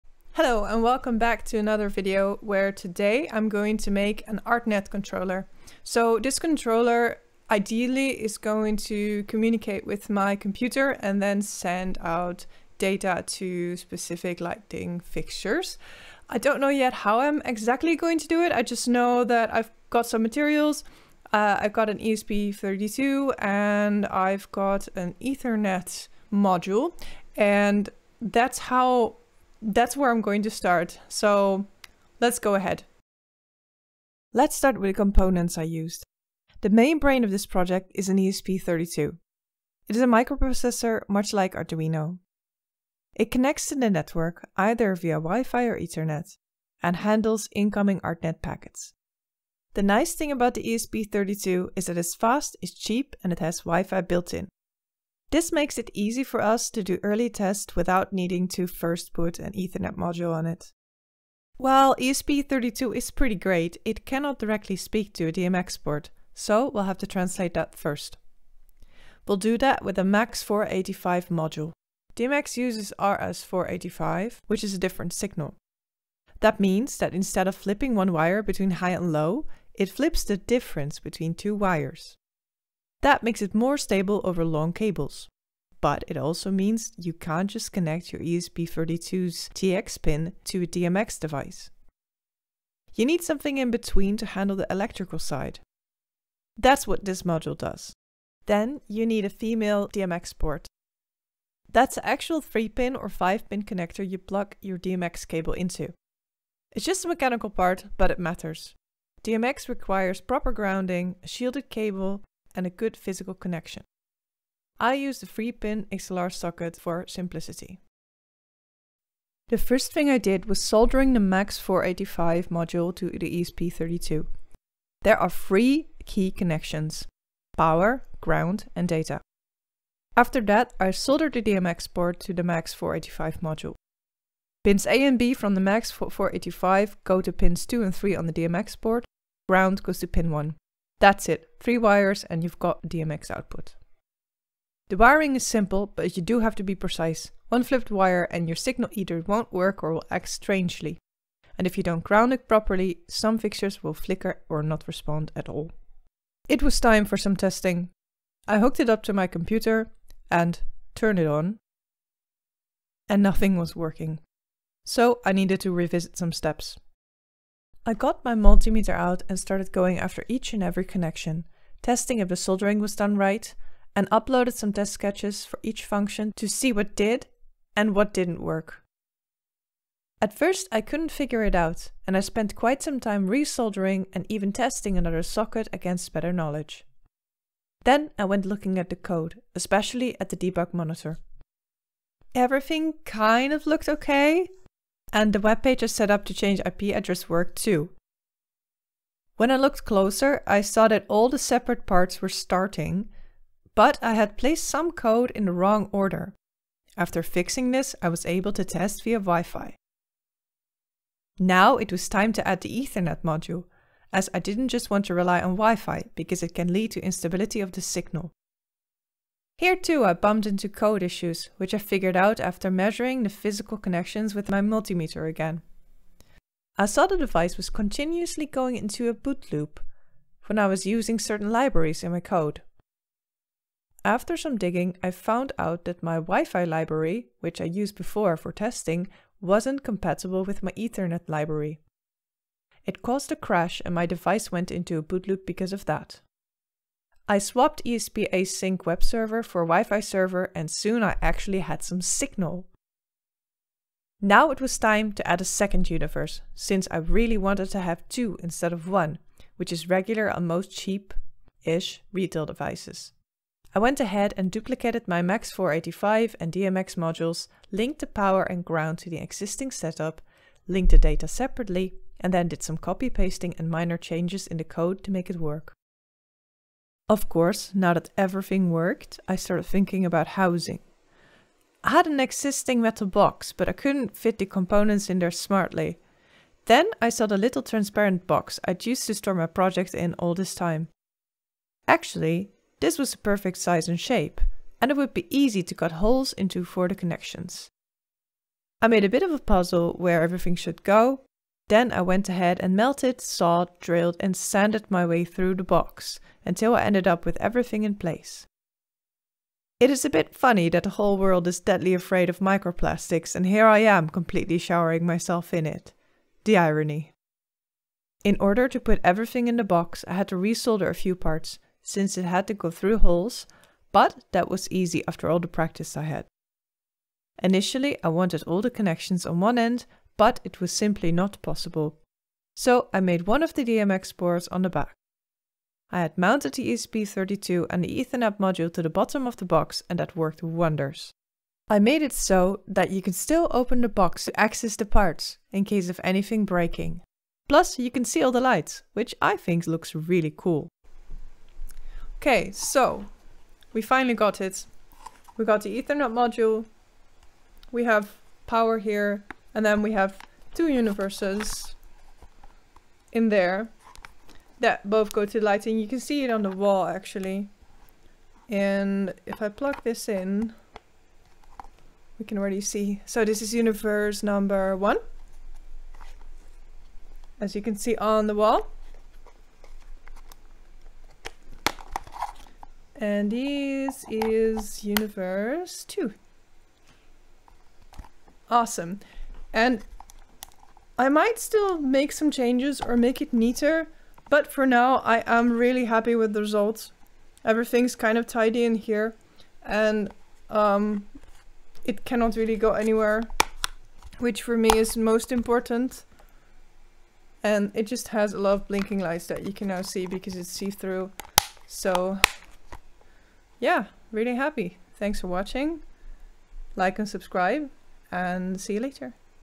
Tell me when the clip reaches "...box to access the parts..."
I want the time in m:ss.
5:43.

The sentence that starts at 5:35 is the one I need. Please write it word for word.
I had mounted the ESP32 and the Ethernet module to the bottom of the box and that worked wonders.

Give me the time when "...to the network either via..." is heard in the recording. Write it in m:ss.
0:43.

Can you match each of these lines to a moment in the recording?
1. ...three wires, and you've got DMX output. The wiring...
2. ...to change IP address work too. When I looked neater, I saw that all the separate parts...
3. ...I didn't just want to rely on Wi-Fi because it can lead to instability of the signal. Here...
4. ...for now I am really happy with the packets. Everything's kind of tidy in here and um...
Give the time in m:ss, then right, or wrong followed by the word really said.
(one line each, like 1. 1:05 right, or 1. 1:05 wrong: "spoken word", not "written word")
1. 2:21 right
2. 3:16 wrong: "closer", not "neater"
3. 3:34 right
4. 6:34 wrong: "results", not "packets".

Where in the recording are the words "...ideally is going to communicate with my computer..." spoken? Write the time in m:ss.
0:07.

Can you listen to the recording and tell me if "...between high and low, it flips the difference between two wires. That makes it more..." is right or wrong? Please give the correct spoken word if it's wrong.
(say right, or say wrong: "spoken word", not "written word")
right.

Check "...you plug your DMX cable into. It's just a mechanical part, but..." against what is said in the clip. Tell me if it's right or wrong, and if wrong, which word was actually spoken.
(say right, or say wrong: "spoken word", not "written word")
right.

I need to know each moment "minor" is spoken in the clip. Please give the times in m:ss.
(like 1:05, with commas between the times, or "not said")
4:33.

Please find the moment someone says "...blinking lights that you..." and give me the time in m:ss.
6:48.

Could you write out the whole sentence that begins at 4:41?
I had an existing metal box, but I couldn't fit the components in there smartly.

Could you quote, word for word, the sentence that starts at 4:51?
Actually, this was the perfect size and shape, and it would be easy to cut holes into for the connections.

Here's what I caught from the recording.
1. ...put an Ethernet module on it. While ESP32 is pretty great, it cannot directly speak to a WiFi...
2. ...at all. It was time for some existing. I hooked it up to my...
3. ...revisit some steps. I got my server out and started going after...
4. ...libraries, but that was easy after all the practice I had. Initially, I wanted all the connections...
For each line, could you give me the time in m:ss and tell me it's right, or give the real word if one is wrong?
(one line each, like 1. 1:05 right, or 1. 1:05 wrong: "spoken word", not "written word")
1. 0:59 wrong: "DMX", not "WiFi"
2. 2:35 wrong: "testing", not "existing"
3. 2:45 wrong: "multimeter", not "server"
4. 5:22 wrong: "holes", not "libraries".